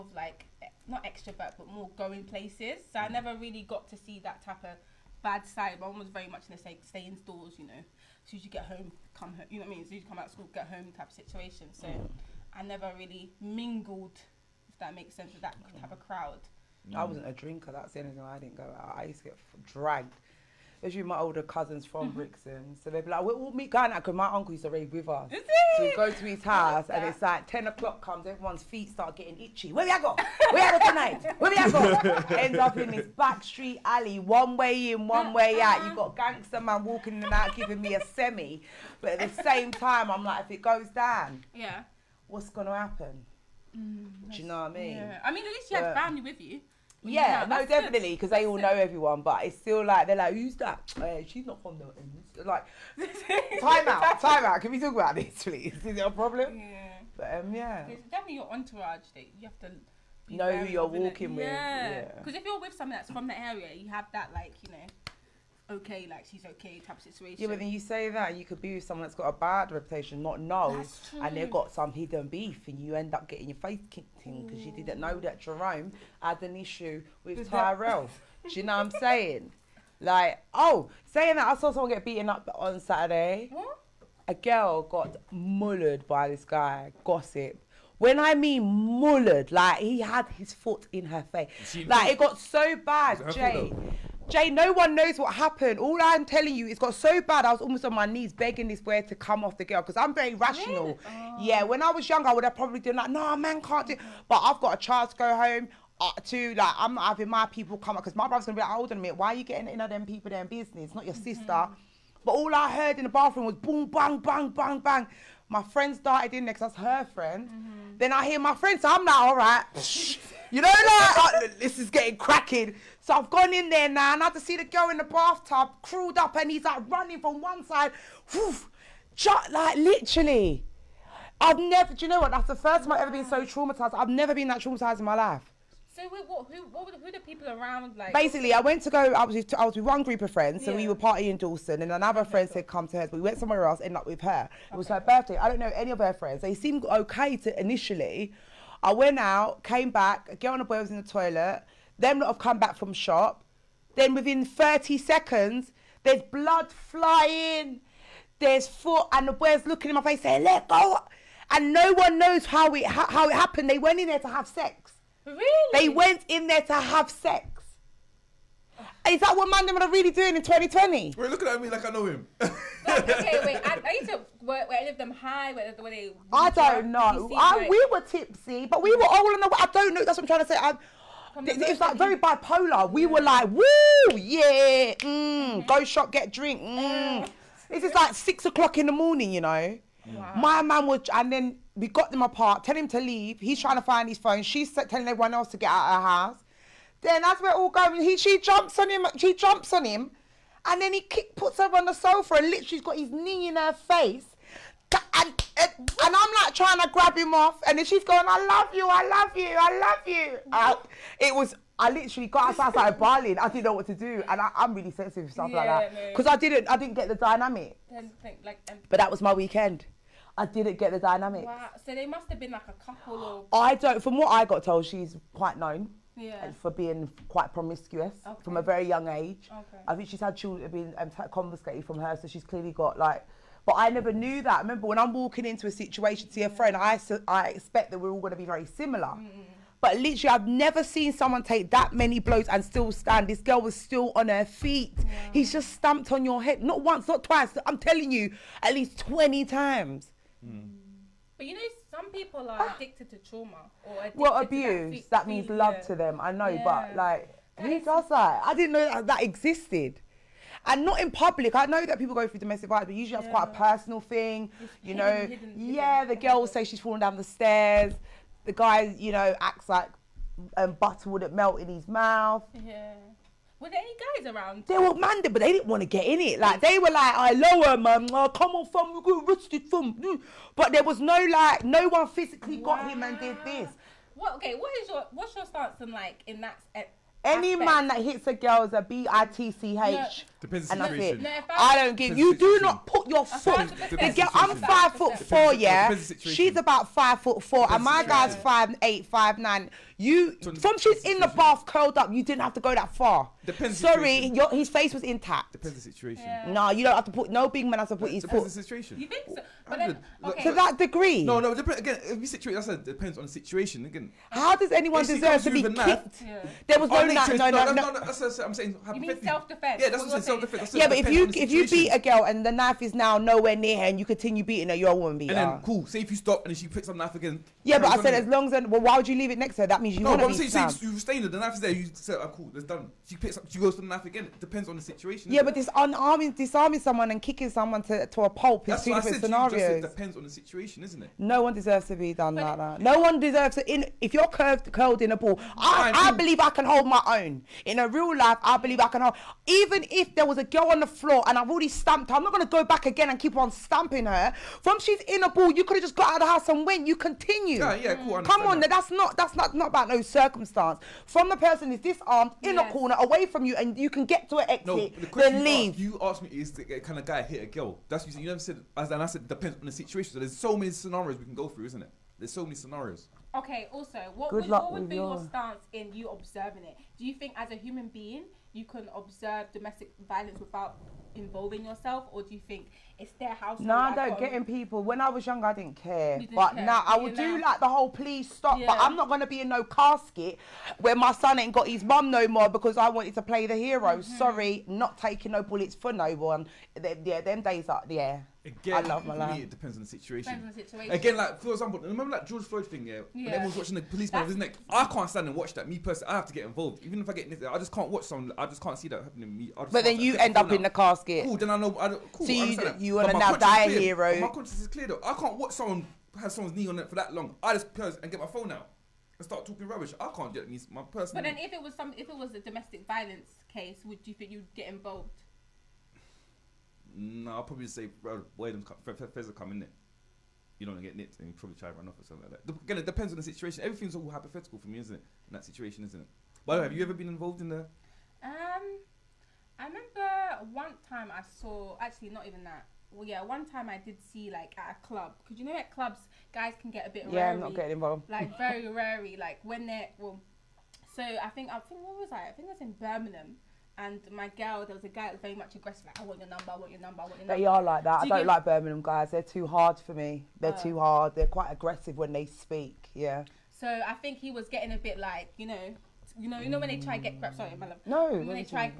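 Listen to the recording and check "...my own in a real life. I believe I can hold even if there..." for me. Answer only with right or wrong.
right.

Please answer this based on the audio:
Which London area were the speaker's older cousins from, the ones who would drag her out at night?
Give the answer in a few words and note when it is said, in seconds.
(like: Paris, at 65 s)
Brixton, at 22 s.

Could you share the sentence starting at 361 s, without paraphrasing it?
From the person is disarmed, in a corner, away from you, and you can get to an exit, no, the then leave.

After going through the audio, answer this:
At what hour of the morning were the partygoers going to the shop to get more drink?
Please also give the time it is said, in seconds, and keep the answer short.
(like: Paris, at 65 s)
6 o'clock, at 188 s.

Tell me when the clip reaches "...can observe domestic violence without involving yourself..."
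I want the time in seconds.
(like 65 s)
378 s.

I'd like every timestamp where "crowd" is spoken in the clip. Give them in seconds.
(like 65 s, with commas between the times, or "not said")
15 s.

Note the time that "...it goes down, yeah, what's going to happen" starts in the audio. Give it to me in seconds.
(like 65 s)
40 s.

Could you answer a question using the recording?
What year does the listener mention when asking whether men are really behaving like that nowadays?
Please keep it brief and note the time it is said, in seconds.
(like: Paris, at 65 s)
2020, at 170 s.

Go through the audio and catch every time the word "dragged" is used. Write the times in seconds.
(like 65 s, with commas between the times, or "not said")
19 s.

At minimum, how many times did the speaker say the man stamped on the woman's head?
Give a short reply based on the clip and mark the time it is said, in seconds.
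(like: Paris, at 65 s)
20, at 249 s.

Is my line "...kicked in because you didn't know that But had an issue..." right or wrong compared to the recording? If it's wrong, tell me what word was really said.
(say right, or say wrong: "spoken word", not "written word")
wrong: "Jerome", not "But".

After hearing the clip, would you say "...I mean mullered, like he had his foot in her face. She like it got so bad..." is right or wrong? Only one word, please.
right.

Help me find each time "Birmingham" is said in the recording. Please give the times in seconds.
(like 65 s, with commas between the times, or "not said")
452 s, 458 s.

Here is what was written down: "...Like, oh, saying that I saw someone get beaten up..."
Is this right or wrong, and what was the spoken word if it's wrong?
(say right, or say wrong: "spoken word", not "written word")
right.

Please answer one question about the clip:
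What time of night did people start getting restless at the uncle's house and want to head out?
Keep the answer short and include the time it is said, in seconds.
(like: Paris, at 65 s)
10 o'clock, at 27 s.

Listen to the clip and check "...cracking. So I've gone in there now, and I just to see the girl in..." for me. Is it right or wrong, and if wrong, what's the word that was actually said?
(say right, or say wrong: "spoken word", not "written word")
right.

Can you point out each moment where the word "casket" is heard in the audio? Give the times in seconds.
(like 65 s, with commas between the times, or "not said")
389 s, 410 s.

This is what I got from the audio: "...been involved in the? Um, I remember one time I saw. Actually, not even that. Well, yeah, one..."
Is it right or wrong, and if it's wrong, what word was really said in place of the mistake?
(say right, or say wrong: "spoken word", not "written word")
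right.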